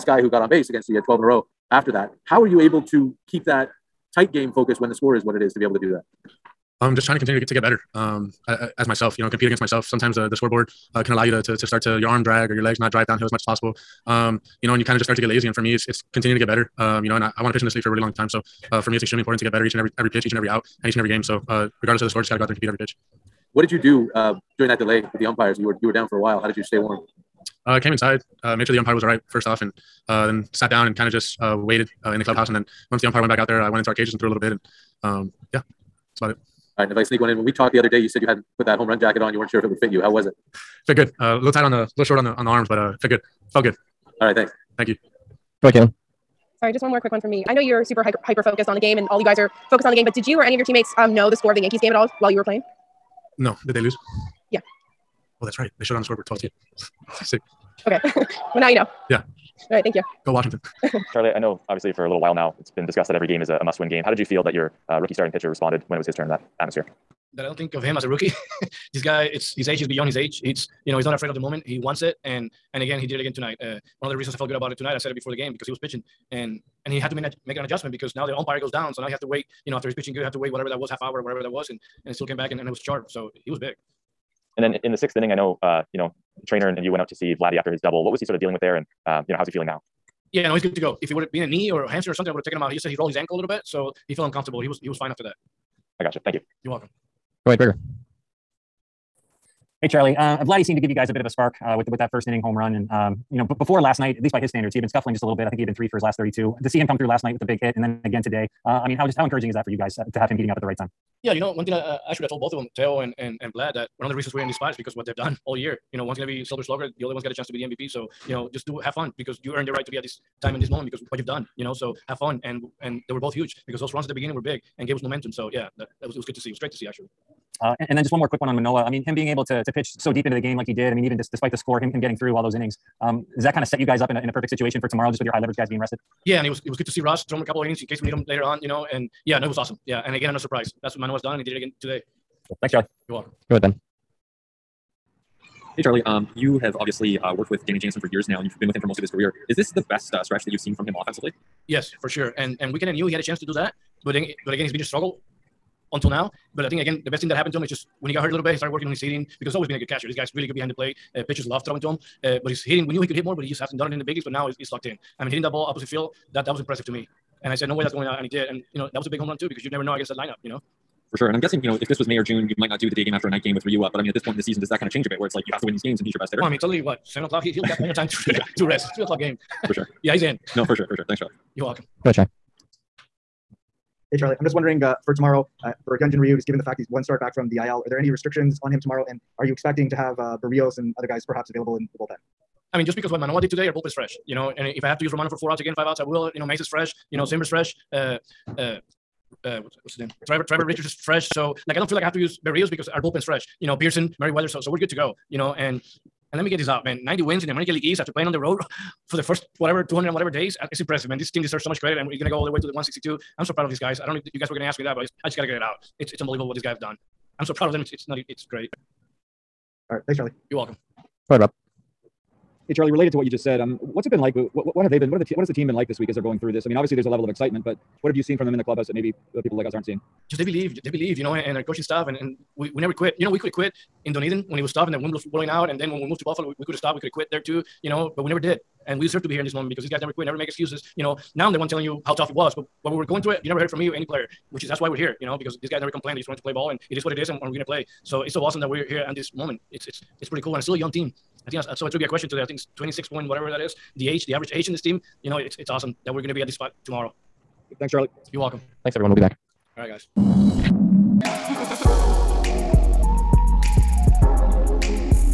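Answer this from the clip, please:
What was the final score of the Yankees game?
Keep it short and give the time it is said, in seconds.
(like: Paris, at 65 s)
12-2, at 56 s.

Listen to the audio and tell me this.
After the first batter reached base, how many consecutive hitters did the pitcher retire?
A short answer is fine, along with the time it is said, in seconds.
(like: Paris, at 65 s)
12, at 1 s.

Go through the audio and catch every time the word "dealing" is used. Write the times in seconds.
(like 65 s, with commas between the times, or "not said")
88 s.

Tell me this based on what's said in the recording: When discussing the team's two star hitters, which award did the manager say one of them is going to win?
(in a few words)
Silver Slugger.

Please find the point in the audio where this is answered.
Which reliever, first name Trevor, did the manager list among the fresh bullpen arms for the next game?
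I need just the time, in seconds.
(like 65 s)
200 s.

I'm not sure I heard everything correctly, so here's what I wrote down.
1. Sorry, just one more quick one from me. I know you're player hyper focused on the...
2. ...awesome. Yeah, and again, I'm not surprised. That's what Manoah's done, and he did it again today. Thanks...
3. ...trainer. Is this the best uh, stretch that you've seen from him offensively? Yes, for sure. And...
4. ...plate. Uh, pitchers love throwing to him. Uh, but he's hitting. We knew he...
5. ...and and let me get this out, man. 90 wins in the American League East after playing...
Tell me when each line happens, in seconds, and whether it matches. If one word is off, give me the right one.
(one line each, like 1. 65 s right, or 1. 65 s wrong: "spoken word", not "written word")
1. 46 s wrong: "super", not "player"
2. 139 s right
3. 149 s wrong: "career", not "trainer"
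4. 160 s right
5. 205 s right.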